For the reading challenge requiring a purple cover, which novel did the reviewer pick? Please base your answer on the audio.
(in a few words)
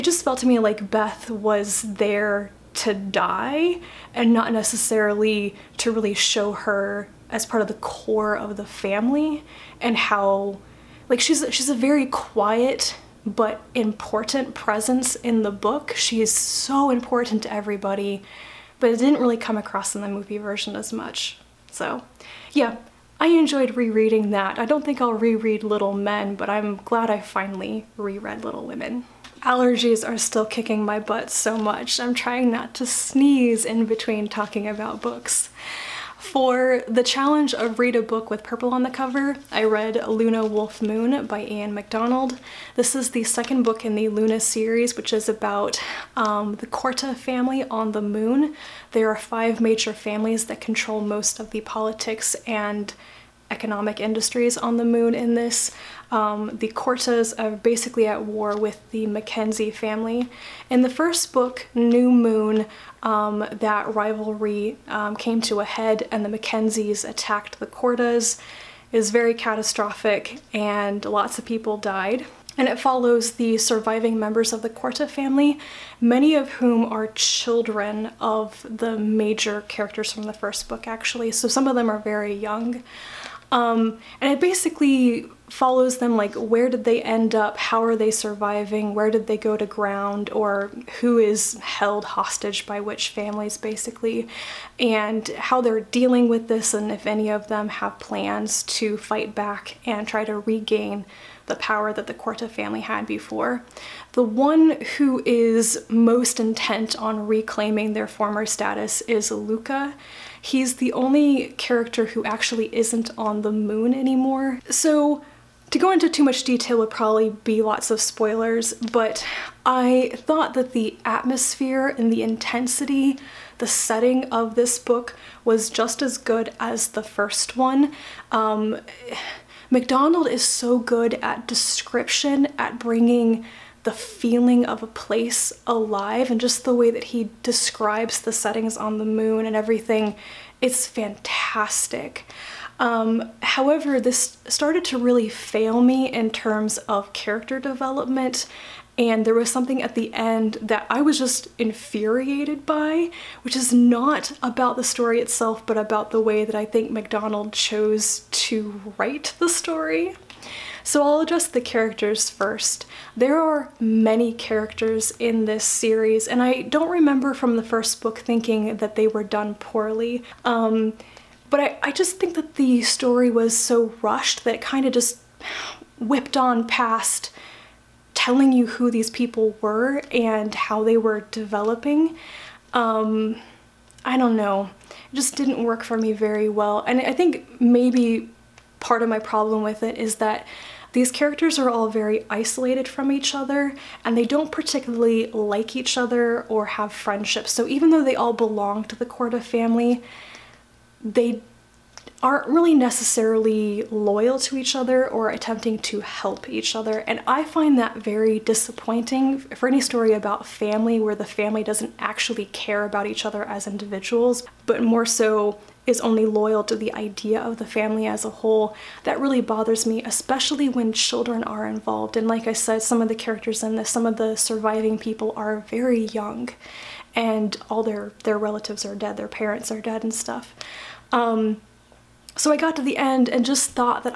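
Luna Wolf Moon.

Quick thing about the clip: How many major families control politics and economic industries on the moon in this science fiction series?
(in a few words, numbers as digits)
5.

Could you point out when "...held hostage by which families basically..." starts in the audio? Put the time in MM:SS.
01:31.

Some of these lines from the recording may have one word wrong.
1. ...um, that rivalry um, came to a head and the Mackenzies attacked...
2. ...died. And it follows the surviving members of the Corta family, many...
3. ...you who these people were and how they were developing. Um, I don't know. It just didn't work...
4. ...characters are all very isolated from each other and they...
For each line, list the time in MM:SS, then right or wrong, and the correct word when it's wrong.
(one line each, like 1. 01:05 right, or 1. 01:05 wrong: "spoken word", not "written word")
1. 01:03 right
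2. 01:11 right
3. 02:58 right
4. 03:11 right.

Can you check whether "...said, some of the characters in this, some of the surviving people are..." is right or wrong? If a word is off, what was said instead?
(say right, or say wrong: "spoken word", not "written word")
right.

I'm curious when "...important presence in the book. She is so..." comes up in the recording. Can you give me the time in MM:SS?
00:13.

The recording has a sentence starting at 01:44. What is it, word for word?
The one who is most intent on reclaiming their former status is Luca.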